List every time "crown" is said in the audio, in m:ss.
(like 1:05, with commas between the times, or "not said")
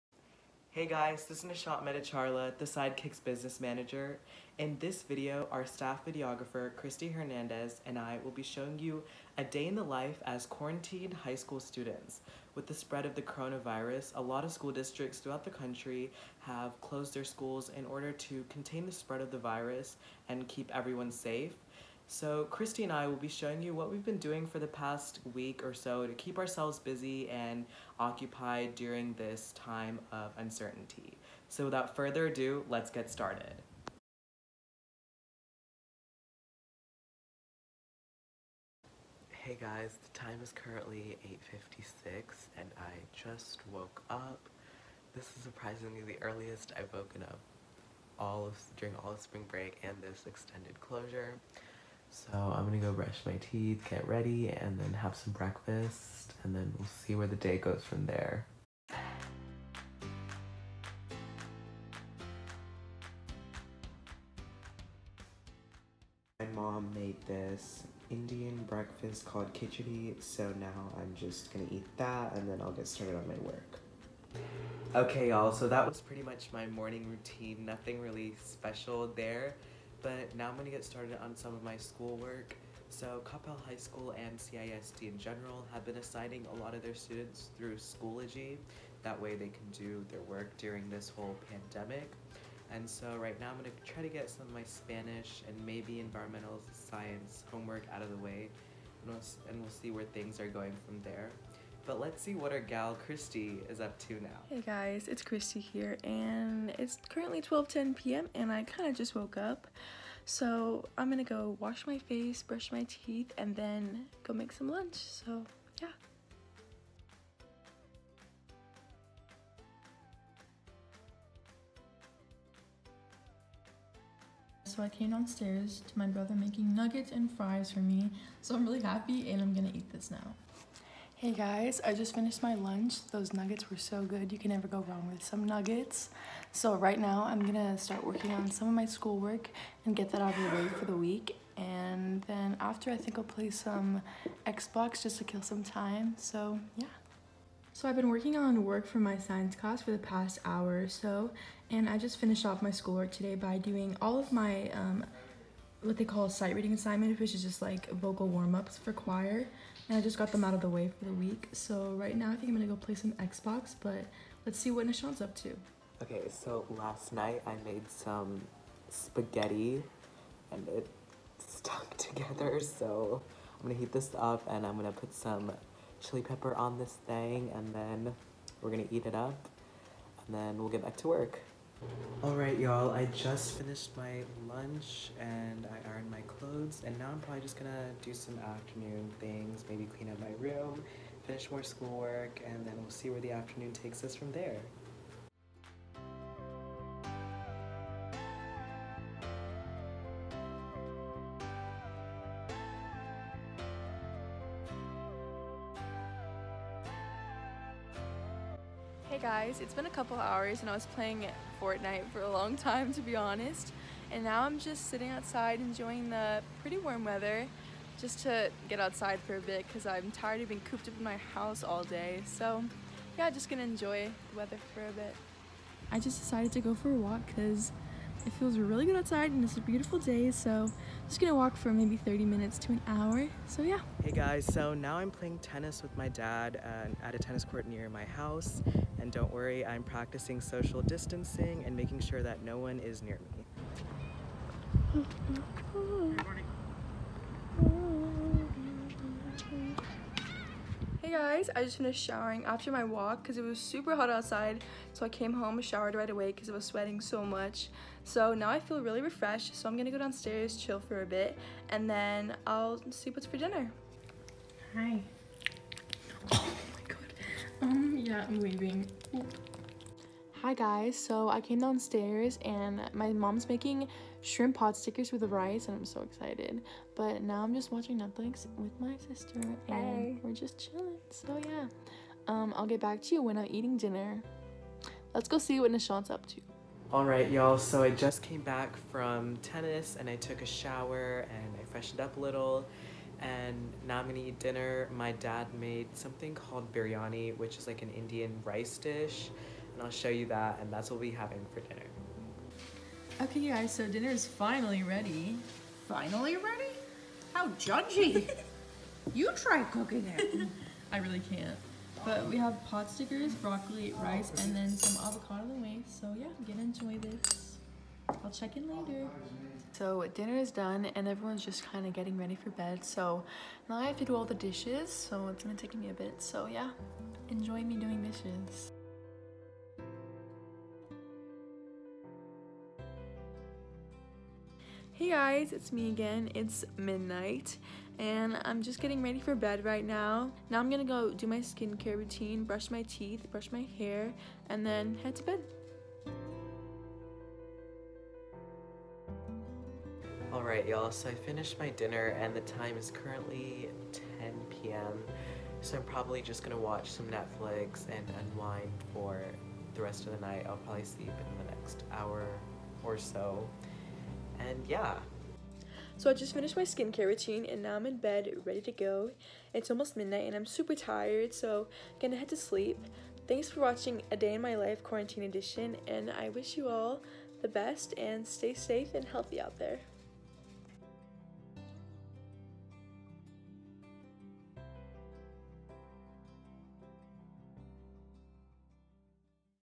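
not said.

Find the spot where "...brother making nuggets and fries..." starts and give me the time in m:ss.
2:06.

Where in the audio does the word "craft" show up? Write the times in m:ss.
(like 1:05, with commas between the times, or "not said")
not said.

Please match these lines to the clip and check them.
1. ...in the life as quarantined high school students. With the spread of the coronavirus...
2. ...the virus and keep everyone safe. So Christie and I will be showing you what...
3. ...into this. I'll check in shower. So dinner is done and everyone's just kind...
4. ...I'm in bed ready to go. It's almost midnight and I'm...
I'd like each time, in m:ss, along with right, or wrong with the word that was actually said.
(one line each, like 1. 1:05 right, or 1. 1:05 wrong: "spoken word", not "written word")
1. 0:09 right
2. 0:19 right
3. 5:16 wrong: "later", not "shower"
4. 6:07 right.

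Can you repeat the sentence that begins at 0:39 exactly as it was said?
Hey guys, the time is currently 8.56 and I just woke up.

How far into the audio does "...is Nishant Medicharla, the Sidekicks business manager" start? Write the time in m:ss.
0:01.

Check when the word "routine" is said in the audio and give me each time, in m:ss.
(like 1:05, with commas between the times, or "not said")
1:17, 5:41, 6:07.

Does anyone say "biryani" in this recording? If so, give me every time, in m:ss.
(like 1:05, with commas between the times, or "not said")
4:56.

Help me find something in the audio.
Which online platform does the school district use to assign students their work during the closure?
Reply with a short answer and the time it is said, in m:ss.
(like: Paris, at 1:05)
Schoology, at 1:27.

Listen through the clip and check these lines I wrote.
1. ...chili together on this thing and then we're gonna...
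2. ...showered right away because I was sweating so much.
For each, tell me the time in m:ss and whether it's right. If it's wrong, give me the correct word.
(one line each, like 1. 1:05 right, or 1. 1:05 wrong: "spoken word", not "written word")
1. 2:55 wrong: "pepper", not "together"
2. 4:15 right.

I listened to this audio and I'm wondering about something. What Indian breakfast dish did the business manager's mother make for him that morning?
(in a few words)
Khichdi.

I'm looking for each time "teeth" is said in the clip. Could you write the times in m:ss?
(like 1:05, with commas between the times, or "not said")
0:53, 1:52, 5:42.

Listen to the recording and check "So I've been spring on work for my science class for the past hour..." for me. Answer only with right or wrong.
wrong.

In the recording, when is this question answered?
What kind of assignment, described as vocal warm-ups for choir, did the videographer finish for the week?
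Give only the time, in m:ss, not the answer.
2:36.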